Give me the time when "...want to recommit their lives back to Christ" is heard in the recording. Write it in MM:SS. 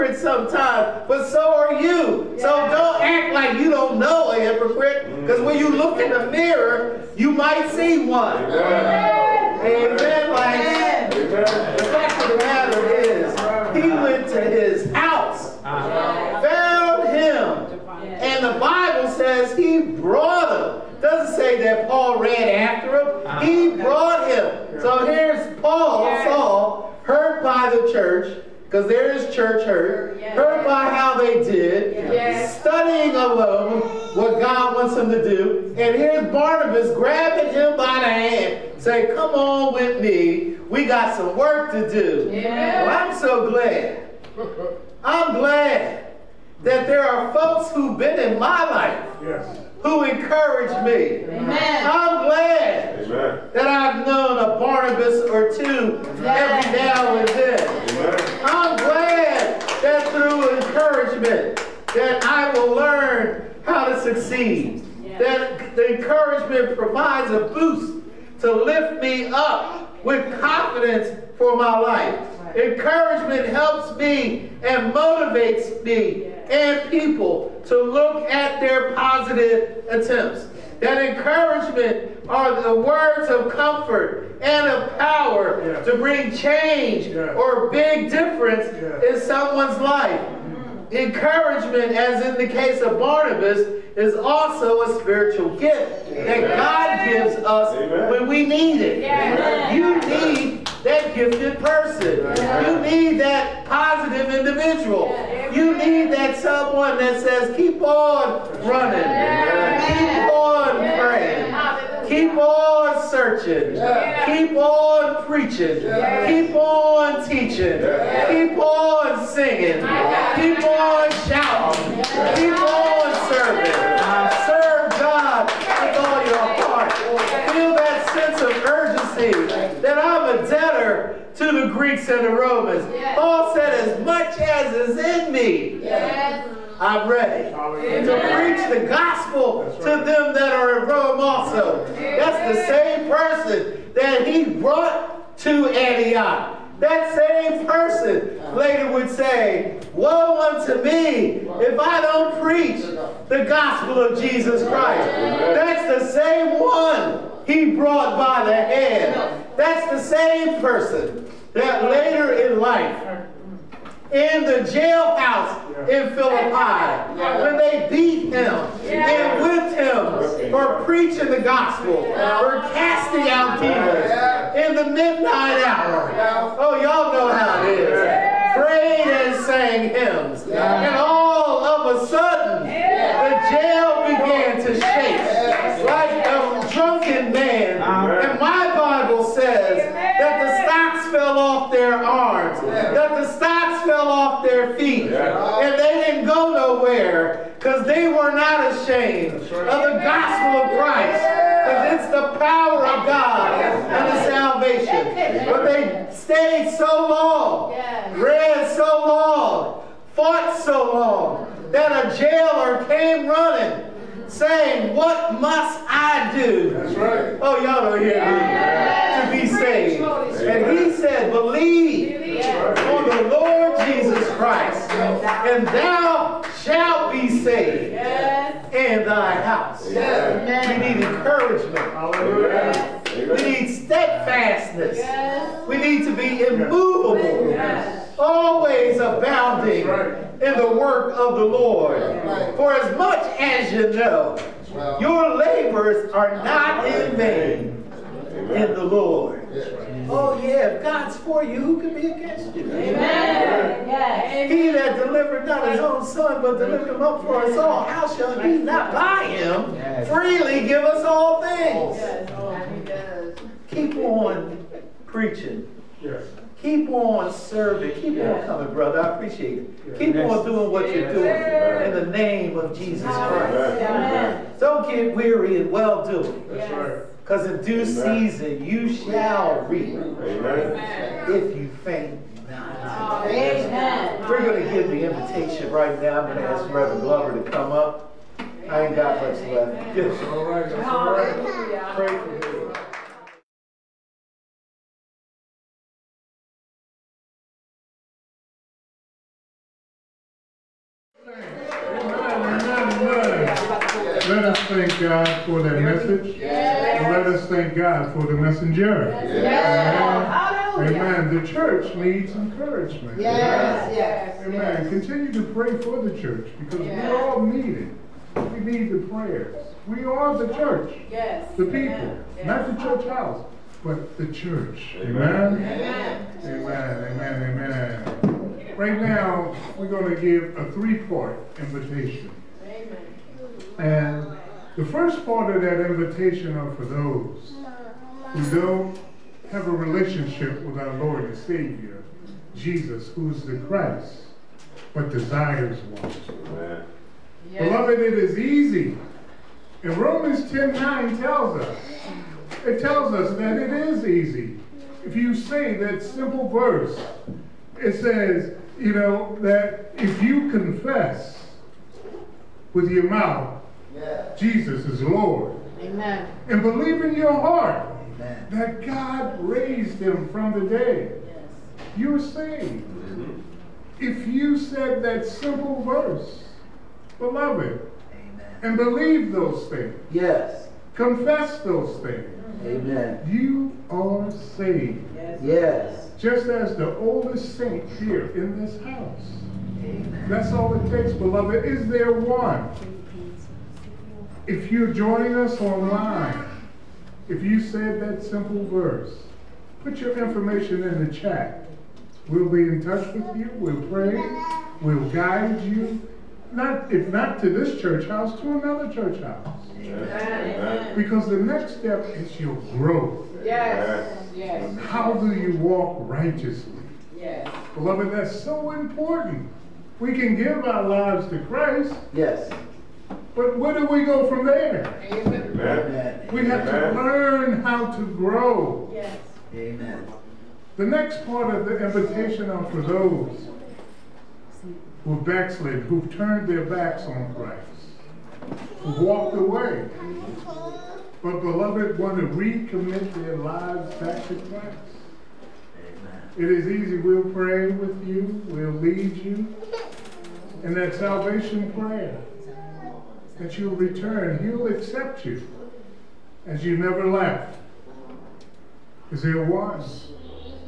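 07:21.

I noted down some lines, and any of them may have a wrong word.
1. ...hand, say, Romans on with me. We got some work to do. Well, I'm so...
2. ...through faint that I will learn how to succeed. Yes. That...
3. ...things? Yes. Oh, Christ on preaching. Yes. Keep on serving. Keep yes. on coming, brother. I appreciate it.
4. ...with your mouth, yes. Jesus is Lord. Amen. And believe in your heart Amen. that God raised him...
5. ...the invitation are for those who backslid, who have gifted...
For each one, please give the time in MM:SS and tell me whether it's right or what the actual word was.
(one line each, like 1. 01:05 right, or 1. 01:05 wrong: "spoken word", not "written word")
1. 00:38 wrong: "Come", not "Romans"
2. 01:00 wrong: "encouragement", not "faint"
3. 04:21 wrong: "Keep", not "Christ"
4. 06:02 right
5. 07:11 wrong: "turned", not "gifted".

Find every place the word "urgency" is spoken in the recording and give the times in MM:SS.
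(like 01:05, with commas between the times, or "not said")
02:08.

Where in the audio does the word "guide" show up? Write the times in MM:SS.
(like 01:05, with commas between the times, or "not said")
06:45.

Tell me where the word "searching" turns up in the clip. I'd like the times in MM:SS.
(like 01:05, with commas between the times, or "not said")
01:53.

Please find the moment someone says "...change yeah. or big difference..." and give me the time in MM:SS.
01:26.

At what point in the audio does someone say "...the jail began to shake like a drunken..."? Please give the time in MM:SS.
03:02.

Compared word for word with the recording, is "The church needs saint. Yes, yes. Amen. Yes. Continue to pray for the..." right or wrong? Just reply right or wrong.
wrong.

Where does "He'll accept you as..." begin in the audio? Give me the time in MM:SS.
07:34.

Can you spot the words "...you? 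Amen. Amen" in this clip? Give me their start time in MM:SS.
04:12.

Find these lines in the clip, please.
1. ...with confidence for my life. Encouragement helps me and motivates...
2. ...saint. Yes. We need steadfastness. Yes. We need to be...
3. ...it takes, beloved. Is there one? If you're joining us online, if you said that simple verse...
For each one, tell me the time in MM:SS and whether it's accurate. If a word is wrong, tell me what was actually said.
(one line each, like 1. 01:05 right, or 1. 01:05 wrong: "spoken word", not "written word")
1. 01:10 right
2. 03:51 wrong: "encouragement", not "saint"
3. 06:30 right.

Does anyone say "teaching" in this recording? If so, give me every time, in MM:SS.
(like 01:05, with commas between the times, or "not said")
01:57.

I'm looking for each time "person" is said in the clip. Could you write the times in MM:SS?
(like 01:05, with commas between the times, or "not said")
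01:41, 02:23, 02:27, 02:40.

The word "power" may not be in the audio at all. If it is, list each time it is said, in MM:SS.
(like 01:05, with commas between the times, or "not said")
01:24, 03:22.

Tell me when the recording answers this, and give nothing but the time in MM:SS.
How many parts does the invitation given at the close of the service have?
05:30.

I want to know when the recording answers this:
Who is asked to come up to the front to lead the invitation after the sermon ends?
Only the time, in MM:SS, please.
04:46.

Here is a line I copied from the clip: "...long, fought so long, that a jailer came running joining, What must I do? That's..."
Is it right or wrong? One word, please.
wrong.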